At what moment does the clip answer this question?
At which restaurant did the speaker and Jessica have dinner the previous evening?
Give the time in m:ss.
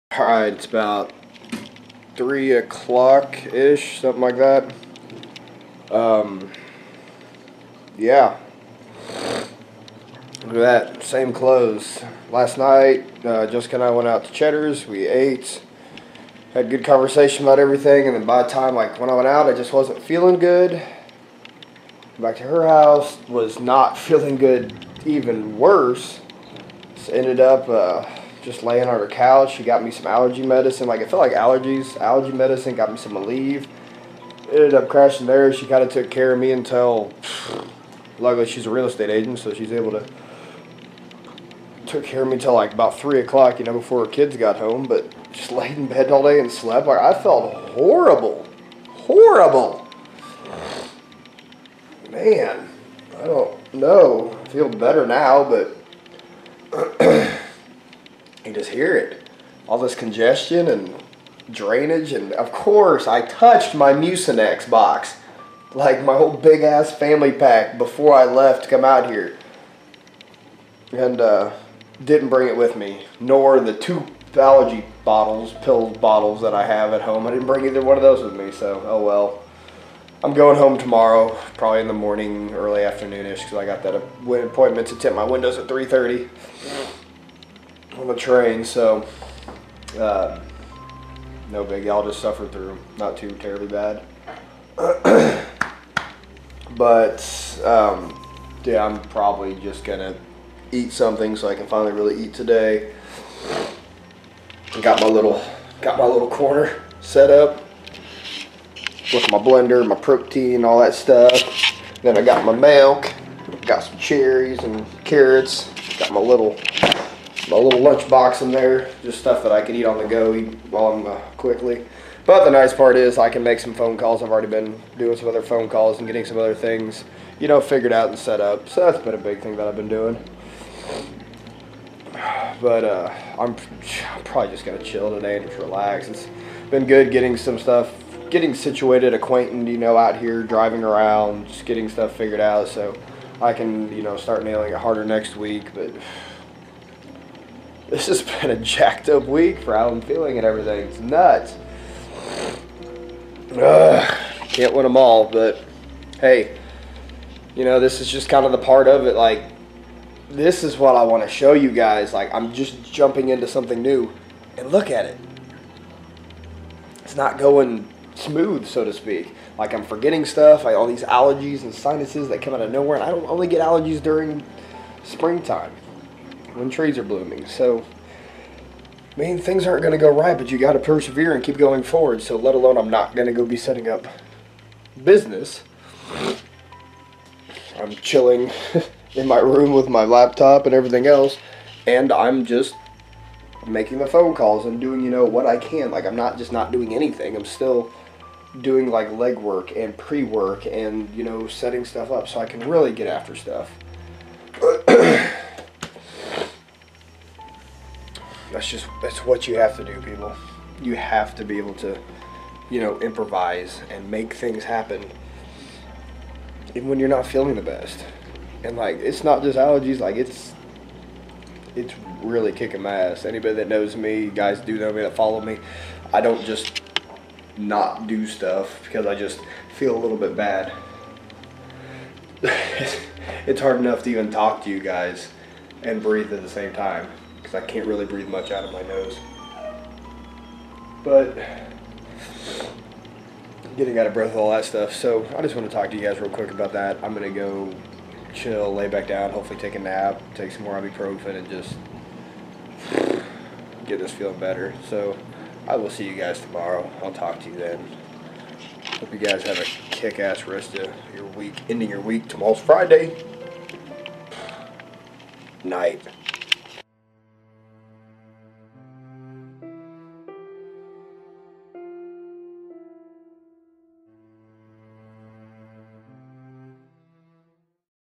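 0:14.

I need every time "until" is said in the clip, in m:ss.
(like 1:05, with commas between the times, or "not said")
0:36, 0:42.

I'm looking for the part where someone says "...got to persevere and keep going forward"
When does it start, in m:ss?
3:00.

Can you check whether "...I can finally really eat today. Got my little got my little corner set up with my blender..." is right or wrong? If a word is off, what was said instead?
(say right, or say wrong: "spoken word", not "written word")
right.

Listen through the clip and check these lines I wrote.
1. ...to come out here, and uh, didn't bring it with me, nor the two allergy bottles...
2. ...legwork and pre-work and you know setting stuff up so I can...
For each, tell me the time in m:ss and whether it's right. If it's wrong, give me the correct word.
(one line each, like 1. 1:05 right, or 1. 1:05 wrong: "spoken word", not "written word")
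1. 1:08 right
2. 3:19 right.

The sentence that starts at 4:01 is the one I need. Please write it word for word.
But getting out of breath, all that stuff.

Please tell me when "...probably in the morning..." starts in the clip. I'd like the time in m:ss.
1:21.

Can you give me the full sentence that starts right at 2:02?
But the nice part is I can make some phone calls.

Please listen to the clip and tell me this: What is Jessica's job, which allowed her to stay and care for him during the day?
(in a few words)
Real estate agent.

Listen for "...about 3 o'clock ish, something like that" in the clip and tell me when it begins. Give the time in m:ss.
0:00.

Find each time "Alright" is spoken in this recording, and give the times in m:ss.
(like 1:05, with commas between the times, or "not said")
0:00.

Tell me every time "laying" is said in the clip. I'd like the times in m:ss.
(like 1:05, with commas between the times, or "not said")
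0:28.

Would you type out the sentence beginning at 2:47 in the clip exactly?
It's not going smooth, so to speak.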